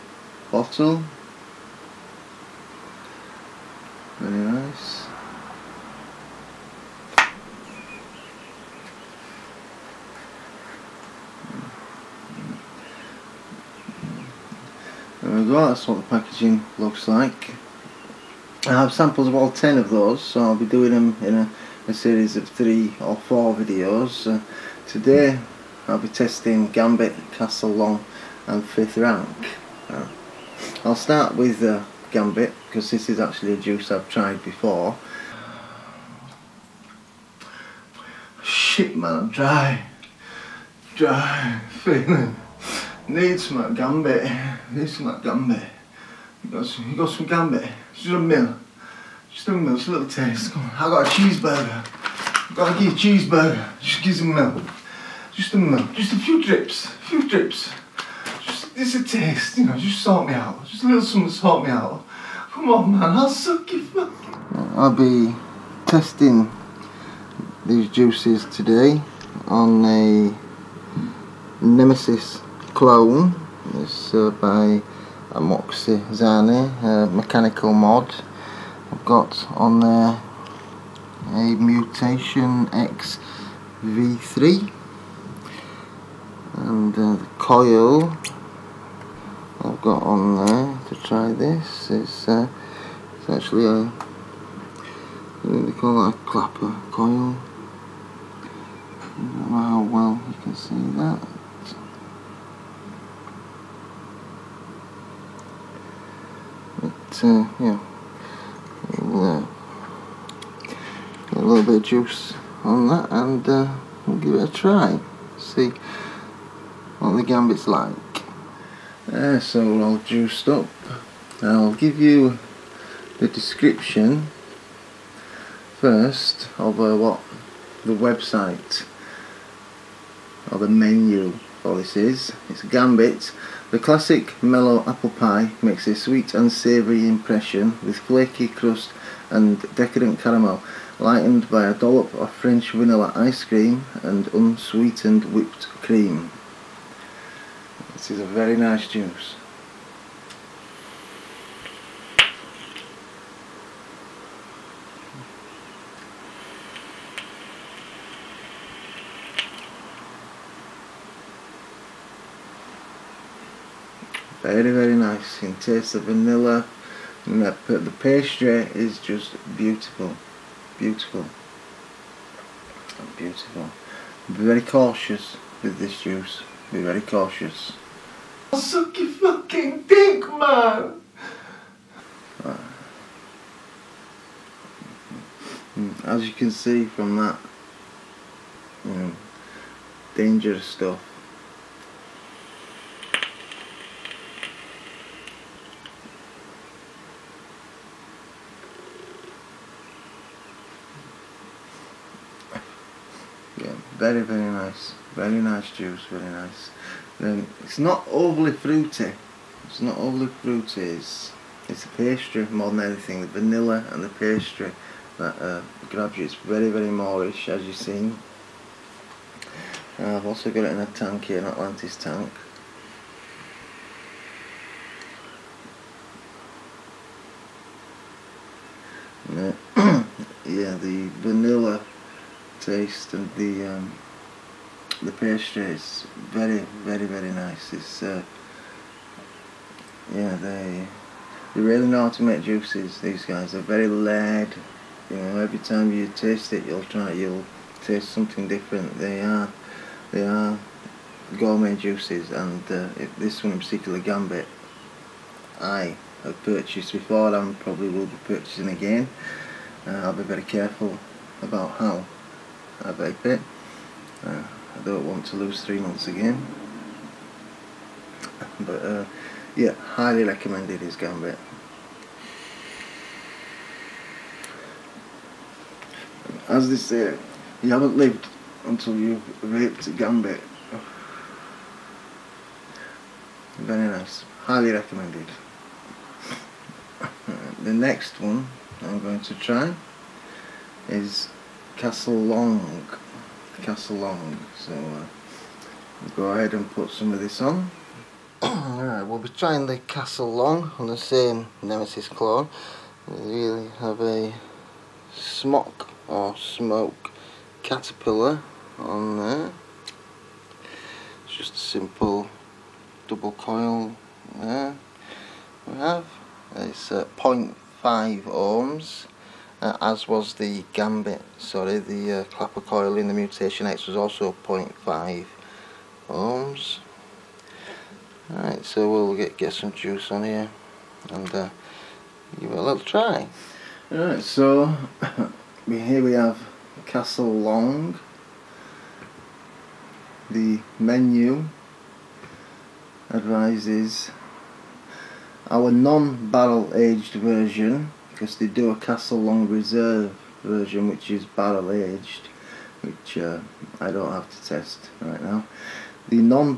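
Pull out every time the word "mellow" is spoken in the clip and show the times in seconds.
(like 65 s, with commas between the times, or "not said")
134 s.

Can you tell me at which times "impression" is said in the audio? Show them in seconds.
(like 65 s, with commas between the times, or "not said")
137 s.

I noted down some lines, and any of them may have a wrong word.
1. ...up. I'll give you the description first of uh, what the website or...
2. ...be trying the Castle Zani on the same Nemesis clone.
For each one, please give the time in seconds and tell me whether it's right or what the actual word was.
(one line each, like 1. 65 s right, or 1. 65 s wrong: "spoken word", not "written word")
1. 120 s right
2. 299 s wrong: "Long", not "Zani".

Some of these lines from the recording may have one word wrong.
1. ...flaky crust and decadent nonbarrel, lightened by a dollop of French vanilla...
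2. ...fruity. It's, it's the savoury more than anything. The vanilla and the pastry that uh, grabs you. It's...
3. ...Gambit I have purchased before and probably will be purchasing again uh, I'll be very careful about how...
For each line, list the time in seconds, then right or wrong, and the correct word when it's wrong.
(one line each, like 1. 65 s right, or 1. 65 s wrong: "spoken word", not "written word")
1. 137 s wrong: "caramel", not "nonbarrel"
2. 210 s wrong: "pastry", not "savoury"
3. 253 s right.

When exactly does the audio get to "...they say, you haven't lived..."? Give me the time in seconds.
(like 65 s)
276 s.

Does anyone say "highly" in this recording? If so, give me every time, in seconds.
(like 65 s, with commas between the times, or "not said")
269 s, 284 s.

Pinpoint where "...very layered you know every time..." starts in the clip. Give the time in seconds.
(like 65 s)
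243 s.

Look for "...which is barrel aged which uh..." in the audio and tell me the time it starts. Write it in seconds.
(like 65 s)
350 s.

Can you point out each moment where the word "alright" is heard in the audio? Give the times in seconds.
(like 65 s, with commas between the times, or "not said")
298 s, 333 s.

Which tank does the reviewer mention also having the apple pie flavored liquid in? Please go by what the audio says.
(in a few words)
Atlantis.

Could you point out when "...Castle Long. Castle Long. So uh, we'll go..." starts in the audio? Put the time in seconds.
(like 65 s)
291 s.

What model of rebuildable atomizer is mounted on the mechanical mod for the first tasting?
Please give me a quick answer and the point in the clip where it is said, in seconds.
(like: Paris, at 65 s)
Mutation X V3, at 81 s.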